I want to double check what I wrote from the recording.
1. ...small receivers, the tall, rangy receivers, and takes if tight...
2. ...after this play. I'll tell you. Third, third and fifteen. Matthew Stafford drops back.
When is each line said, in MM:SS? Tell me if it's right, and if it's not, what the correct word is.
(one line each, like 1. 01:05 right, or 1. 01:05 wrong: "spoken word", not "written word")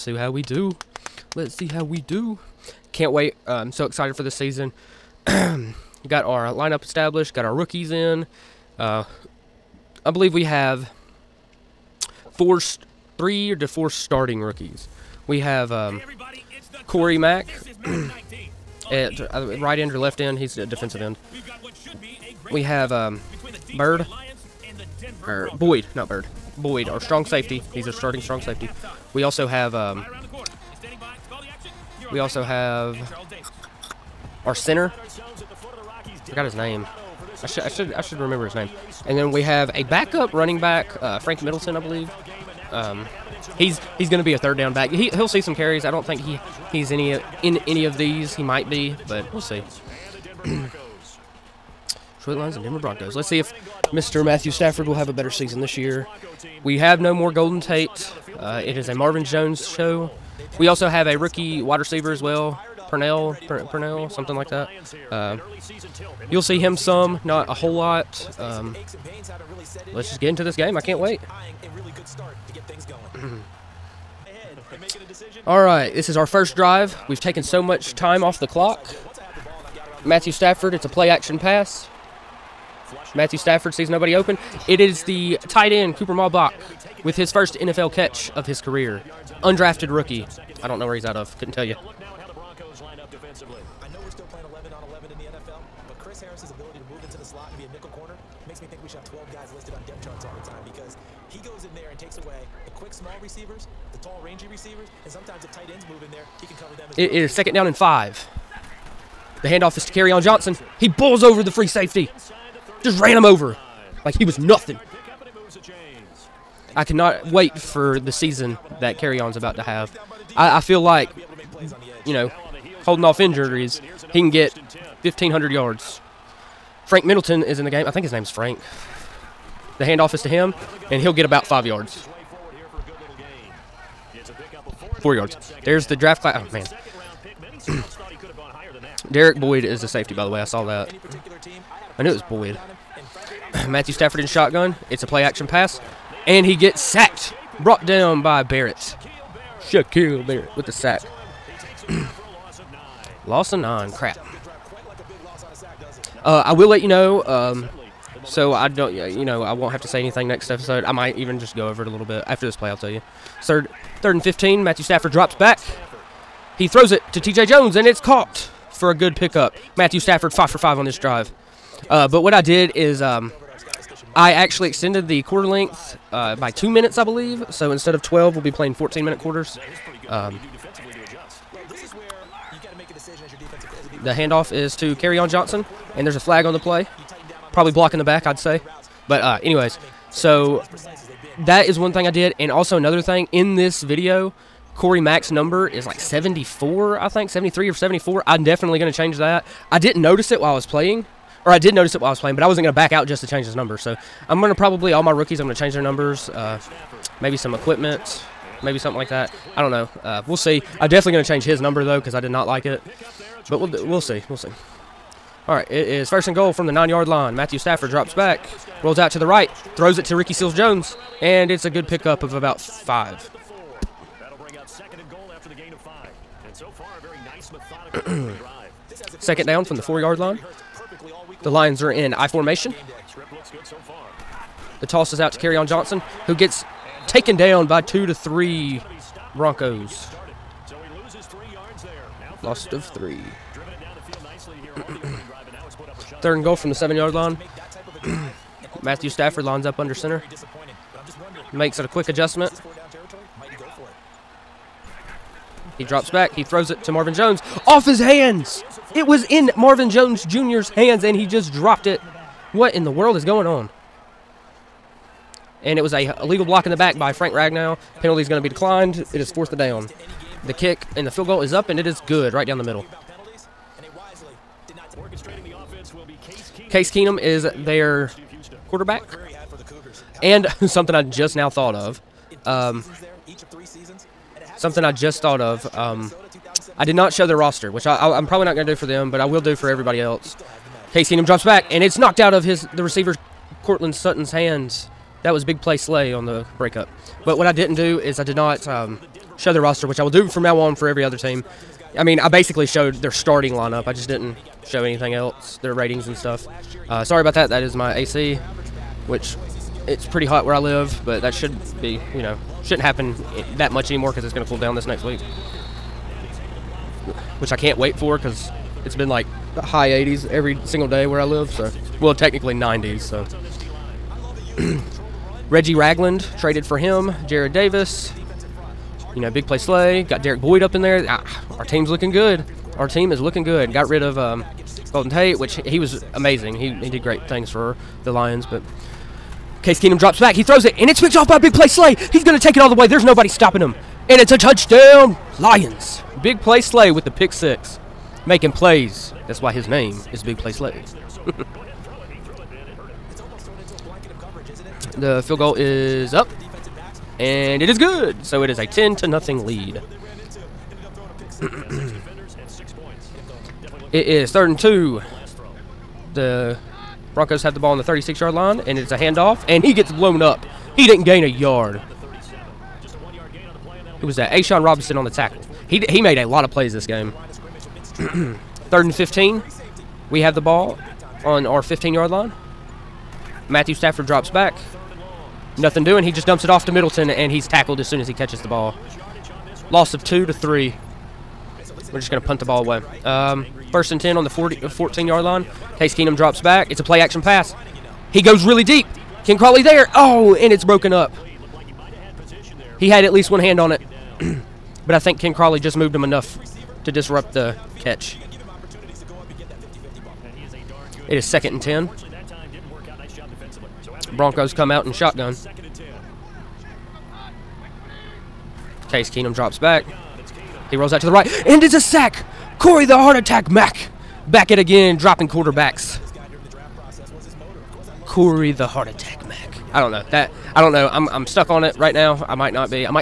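1. 01:42 wrong: "sometimes", not "takes"
2. 02:42 right.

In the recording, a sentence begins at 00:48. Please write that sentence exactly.
He might be, but we'll see.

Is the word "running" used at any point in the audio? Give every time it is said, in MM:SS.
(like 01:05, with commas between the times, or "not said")
00:40.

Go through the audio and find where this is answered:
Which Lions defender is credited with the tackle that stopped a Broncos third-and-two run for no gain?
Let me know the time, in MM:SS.
06:14.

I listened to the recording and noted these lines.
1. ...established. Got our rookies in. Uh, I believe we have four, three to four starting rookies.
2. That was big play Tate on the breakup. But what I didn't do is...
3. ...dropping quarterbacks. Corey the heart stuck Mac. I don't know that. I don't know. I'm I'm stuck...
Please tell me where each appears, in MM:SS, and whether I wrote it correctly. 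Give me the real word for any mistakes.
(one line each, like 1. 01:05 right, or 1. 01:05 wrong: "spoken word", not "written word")
1. 00:06 right
2. 04:55 wrong: "Slay", not "Tate"
3. 07:04 wrong: "attack", not "stuck".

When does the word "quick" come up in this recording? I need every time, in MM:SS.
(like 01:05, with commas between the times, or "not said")
01:42, 04:11.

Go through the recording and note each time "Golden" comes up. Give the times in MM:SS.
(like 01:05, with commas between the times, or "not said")
00:57, 05:34.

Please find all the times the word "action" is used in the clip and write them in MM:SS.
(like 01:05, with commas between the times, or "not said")
01:21, 02:25, 06:37.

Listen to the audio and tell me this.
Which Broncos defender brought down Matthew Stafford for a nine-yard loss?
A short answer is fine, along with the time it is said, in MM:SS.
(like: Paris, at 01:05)
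Shaquille Barrett, at 02:29.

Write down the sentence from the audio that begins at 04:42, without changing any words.
Um, something I just thought of.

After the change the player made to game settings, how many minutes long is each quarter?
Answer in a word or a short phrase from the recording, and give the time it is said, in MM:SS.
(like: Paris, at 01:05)
14, at 02:58.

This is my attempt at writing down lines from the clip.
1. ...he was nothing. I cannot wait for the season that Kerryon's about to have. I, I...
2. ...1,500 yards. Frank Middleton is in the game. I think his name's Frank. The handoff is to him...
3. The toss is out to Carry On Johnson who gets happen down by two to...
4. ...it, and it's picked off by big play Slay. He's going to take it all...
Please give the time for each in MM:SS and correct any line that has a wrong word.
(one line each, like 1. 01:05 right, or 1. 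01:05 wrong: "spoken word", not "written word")
1. 01:54 right
2. 02:05 right
3. 03:54 wrong: "taken", not "happen"
4. 05:40 right.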